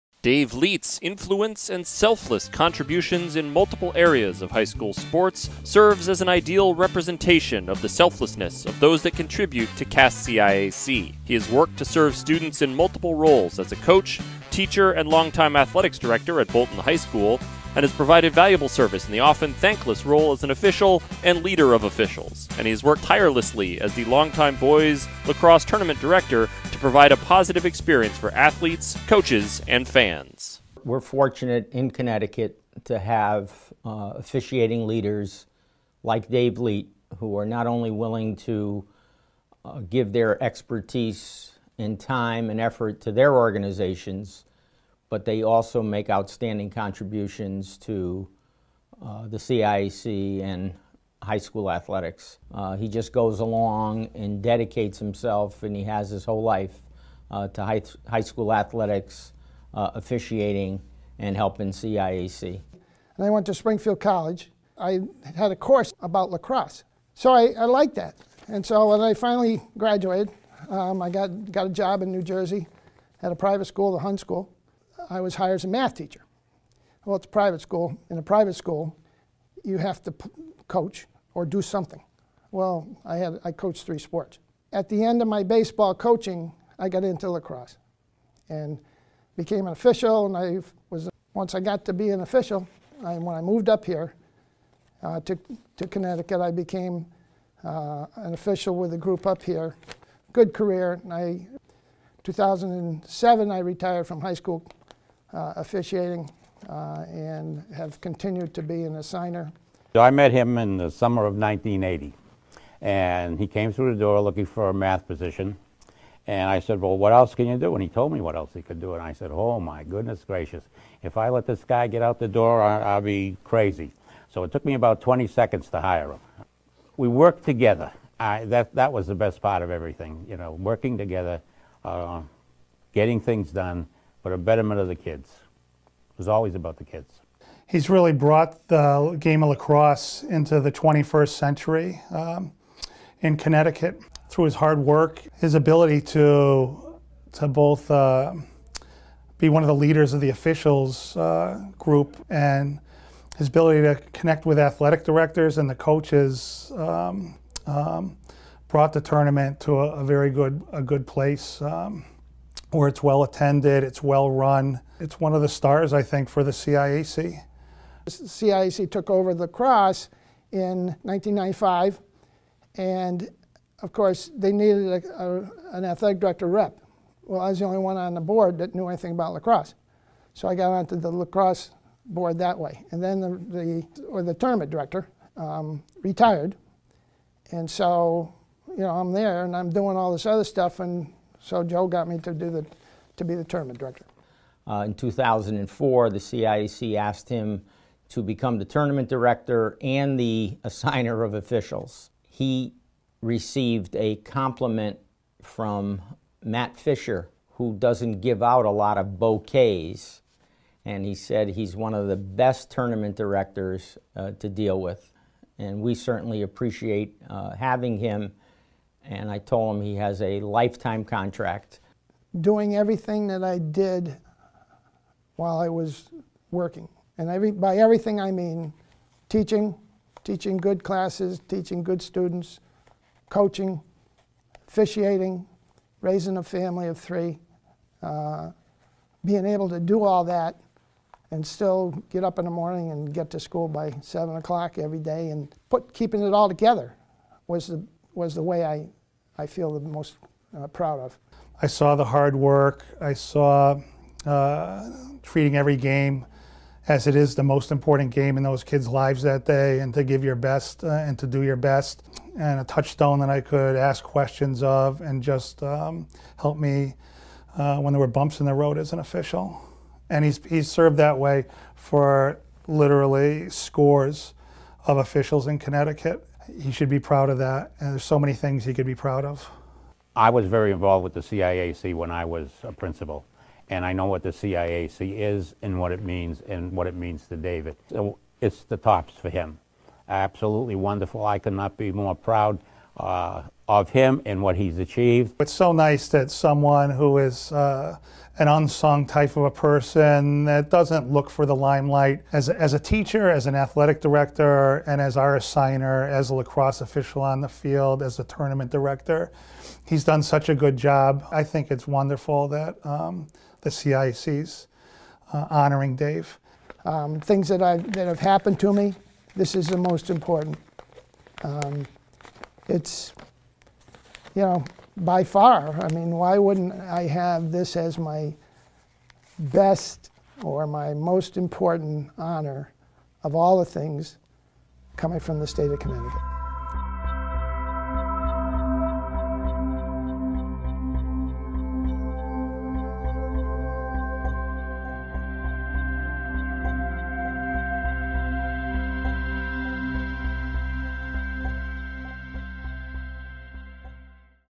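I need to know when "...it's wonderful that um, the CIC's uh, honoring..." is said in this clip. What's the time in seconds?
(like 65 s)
311 s.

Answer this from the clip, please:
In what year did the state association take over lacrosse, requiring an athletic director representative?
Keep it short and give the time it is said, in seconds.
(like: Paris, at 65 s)
1995, at 171 s.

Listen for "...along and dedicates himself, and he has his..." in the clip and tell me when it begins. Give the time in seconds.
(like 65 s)
53 s.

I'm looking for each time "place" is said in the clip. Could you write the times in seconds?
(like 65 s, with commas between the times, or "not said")
161 s.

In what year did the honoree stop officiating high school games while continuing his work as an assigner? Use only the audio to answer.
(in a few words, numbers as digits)
2007.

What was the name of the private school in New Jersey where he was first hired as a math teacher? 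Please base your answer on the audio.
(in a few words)
The Hun School.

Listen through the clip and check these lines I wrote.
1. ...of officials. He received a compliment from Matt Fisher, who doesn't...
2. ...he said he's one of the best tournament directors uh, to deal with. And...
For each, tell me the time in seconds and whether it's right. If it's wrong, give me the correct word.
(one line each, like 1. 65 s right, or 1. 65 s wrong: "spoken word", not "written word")
1. 201 s right
2. 211 s right.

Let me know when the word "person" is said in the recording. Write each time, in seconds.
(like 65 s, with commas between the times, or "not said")
299 s.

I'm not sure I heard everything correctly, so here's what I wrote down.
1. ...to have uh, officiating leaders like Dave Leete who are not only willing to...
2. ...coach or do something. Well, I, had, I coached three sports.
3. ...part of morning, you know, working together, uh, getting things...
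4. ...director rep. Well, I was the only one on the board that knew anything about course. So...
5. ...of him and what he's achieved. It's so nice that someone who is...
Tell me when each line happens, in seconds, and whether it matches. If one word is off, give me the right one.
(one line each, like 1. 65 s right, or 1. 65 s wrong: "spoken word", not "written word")
1. 32 s right
2. 80 s right
3. 129 s wrong: "everything", not "morning"
4. 176 s wrong: "lacrosse", not "course"
5. 293 s right.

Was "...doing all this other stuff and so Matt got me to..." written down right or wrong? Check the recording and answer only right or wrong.
wrong.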